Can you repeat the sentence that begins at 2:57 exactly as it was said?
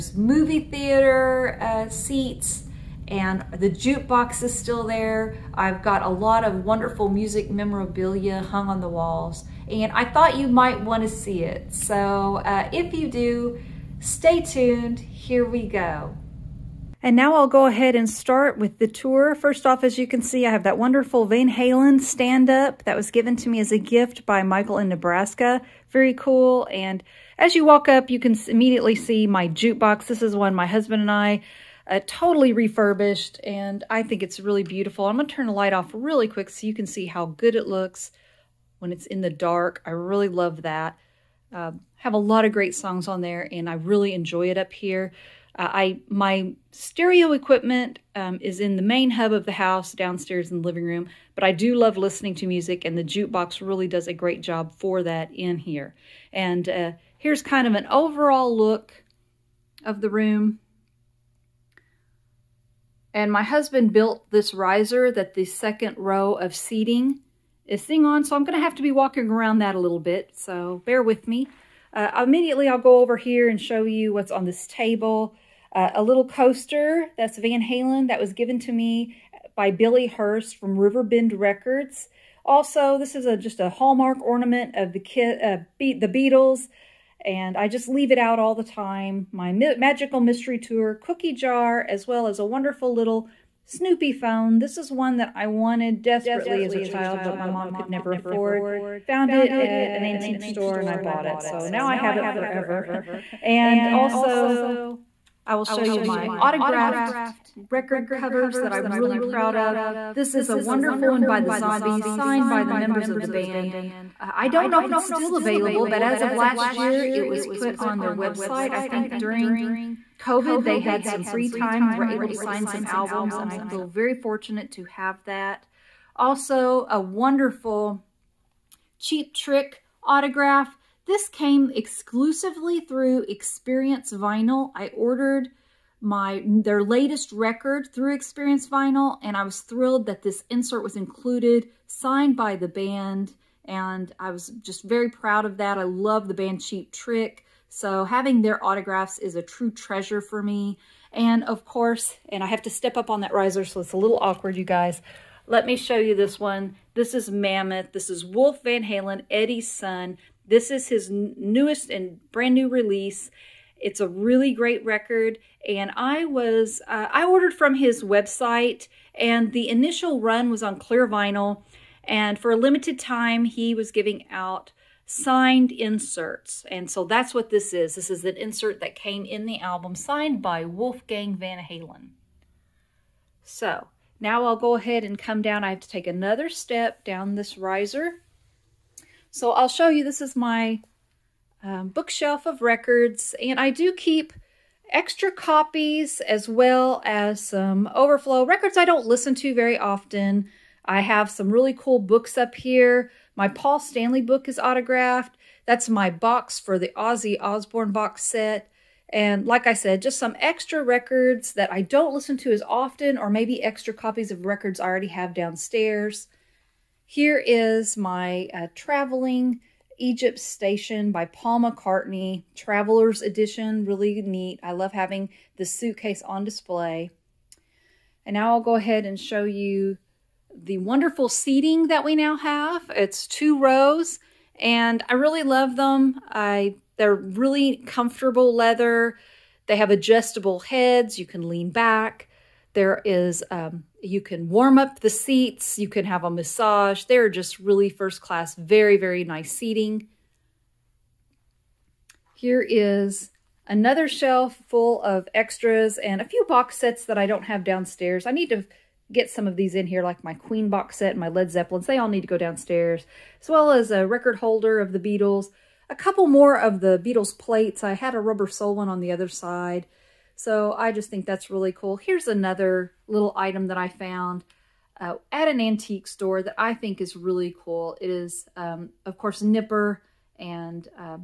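This is an insert that came in the album, signed by Wolfgang Van Halen.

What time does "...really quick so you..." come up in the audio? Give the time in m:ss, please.
0:35.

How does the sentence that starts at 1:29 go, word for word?
My Magical Mystery Tour cookie jar, as well as a wonderful little Snoopy phone.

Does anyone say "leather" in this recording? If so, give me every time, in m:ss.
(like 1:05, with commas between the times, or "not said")
3:58.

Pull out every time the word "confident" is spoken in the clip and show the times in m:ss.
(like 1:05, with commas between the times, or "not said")
not said.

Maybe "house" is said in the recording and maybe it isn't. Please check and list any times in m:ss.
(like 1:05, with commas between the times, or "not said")
0:49.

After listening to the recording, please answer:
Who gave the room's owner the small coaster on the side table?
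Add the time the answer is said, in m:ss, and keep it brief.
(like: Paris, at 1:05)
Billy Hurst, at 1:19.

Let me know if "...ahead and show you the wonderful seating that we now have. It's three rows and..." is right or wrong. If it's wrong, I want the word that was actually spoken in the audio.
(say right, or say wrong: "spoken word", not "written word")
wrong: "two", not "three".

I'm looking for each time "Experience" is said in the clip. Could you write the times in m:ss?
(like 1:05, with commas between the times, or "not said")
2:13, 2:18.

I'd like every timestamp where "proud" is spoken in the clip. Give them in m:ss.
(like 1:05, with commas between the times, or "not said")
1:49, 2:25.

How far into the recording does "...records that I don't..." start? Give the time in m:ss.
3:30.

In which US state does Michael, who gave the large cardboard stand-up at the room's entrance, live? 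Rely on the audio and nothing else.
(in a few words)
Nebraska.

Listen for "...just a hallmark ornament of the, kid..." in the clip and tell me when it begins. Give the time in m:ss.
1:23.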